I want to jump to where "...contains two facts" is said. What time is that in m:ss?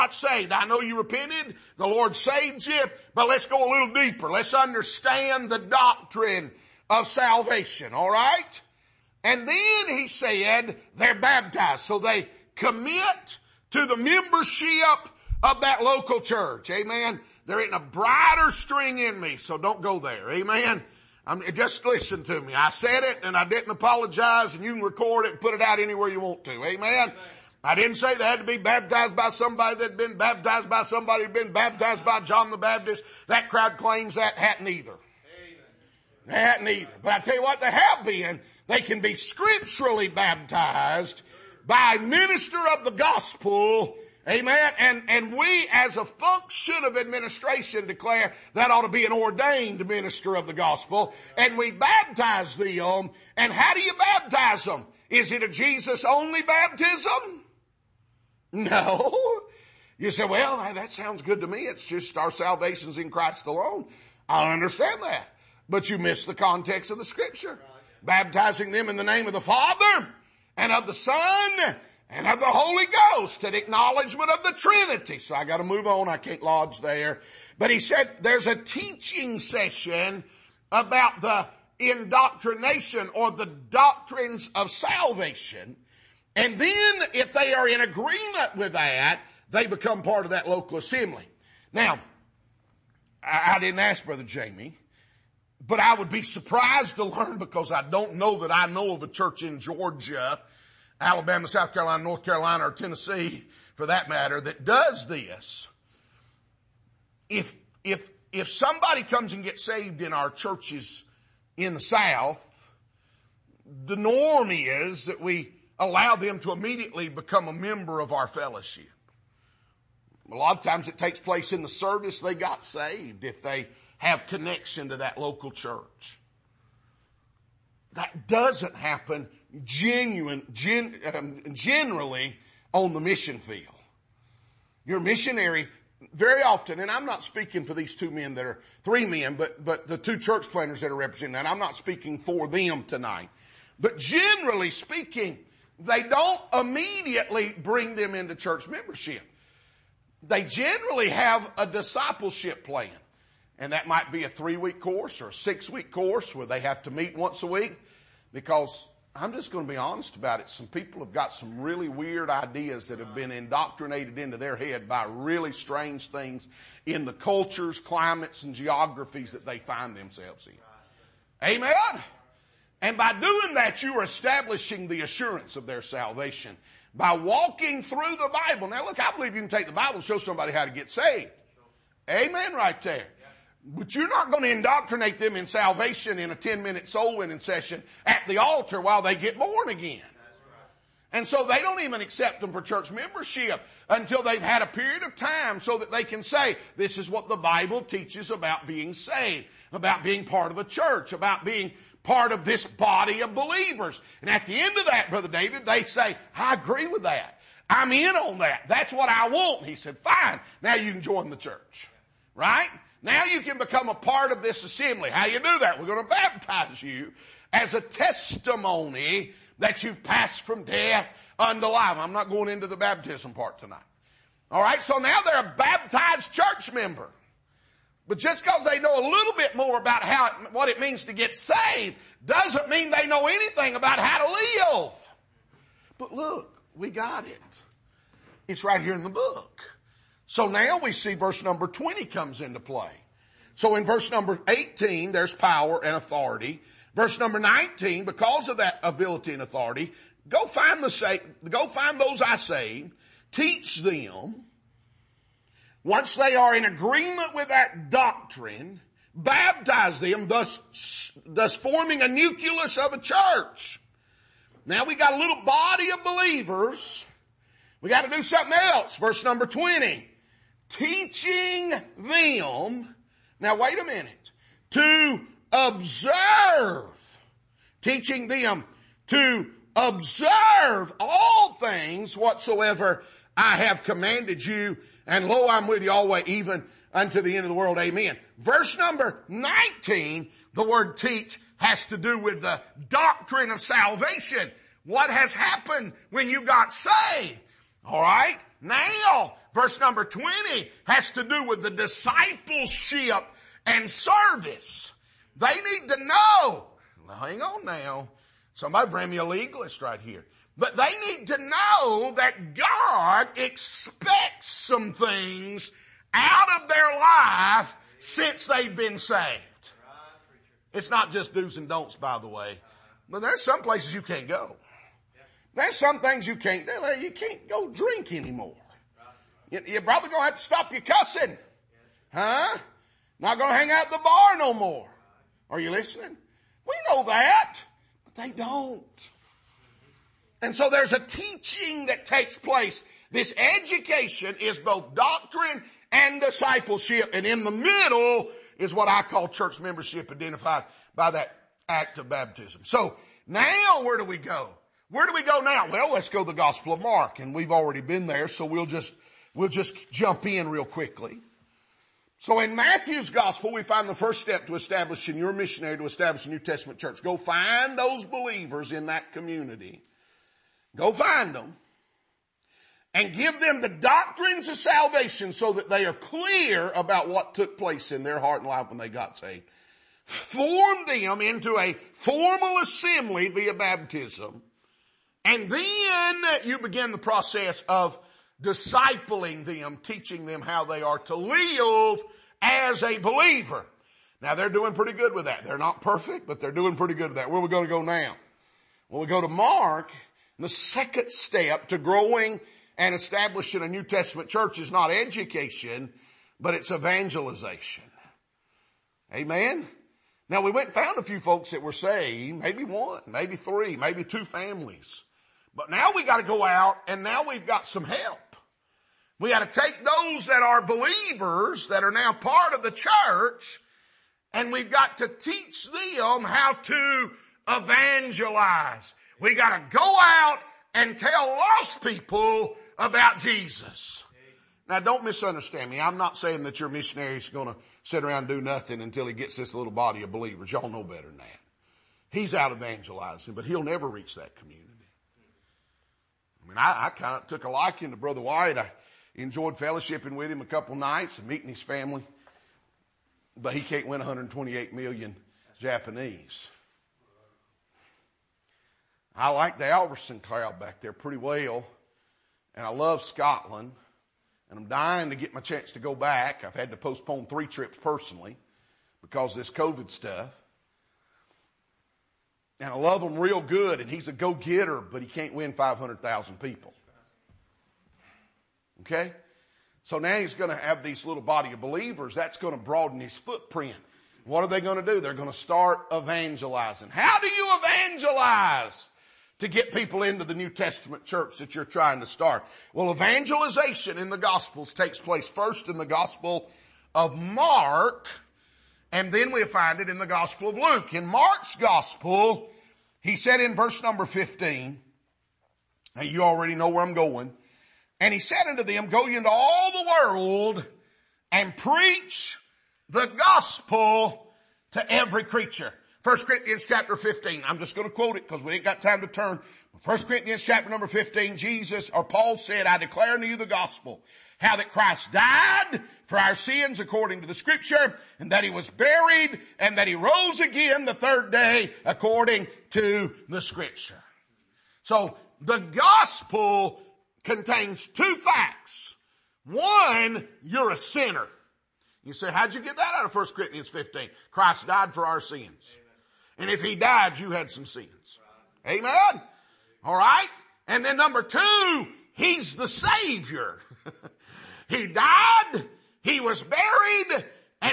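8:57.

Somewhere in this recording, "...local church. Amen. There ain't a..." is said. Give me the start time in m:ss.
0:15.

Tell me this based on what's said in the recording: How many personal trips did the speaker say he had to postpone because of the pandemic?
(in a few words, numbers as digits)
3.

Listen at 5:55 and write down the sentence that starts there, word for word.
Well, let's go to the Gospel of Mark.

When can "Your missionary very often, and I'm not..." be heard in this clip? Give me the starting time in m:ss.
2:14.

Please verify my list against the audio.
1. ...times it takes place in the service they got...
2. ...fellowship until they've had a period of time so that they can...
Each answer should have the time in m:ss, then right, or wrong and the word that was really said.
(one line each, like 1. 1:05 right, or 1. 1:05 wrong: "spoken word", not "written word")
1. 2:00 right
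2. 3:12 wrong: "membership", not "fellowship".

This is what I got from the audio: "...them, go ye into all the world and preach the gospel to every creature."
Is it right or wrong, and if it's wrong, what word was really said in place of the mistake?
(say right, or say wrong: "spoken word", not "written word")
right.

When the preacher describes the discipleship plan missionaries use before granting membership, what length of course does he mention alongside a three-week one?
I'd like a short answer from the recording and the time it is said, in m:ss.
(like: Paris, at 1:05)
6 week course, at 2:35.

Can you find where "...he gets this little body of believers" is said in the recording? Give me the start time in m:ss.
7:19.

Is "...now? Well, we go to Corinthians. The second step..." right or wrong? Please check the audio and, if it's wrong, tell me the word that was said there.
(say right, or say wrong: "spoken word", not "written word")
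wrong: "Mark", not "Corinthians".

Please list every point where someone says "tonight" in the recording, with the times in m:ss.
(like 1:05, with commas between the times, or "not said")
2:22, 3:43.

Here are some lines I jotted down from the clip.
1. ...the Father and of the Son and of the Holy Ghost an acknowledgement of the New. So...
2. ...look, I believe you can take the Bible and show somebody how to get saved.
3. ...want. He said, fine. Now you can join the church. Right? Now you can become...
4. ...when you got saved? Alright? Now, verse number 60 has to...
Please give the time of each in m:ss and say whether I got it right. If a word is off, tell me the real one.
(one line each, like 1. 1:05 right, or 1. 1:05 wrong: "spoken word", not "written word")
1. 1:09 wrong: "Trinity", not "New"
2. 2:58 right
3. 3:29 right
4. 4:56 wrong: "20", not "60".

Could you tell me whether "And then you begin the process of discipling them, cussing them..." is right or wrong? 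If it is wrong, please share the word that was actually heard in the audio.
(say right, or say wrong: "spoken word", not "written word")
wrong: "teaching", not "cussing".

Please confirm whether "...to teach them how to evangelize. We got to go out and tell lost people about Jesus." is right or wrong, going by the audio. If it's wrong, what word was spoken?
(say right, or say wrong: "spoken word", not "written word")
right.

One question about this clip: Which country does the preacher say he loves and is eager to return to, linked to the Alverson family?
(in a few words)
Scotland.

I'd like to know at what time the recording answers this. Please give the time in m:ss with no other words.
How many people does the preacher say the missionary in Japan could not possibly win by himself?
7:33.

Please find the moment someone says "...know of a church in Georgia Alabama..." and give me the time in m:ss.
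1:38.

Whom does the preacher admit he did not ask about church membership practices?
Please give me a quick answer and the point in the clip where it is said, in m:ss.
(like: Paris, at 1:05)
Brother Jamie, at 1:34.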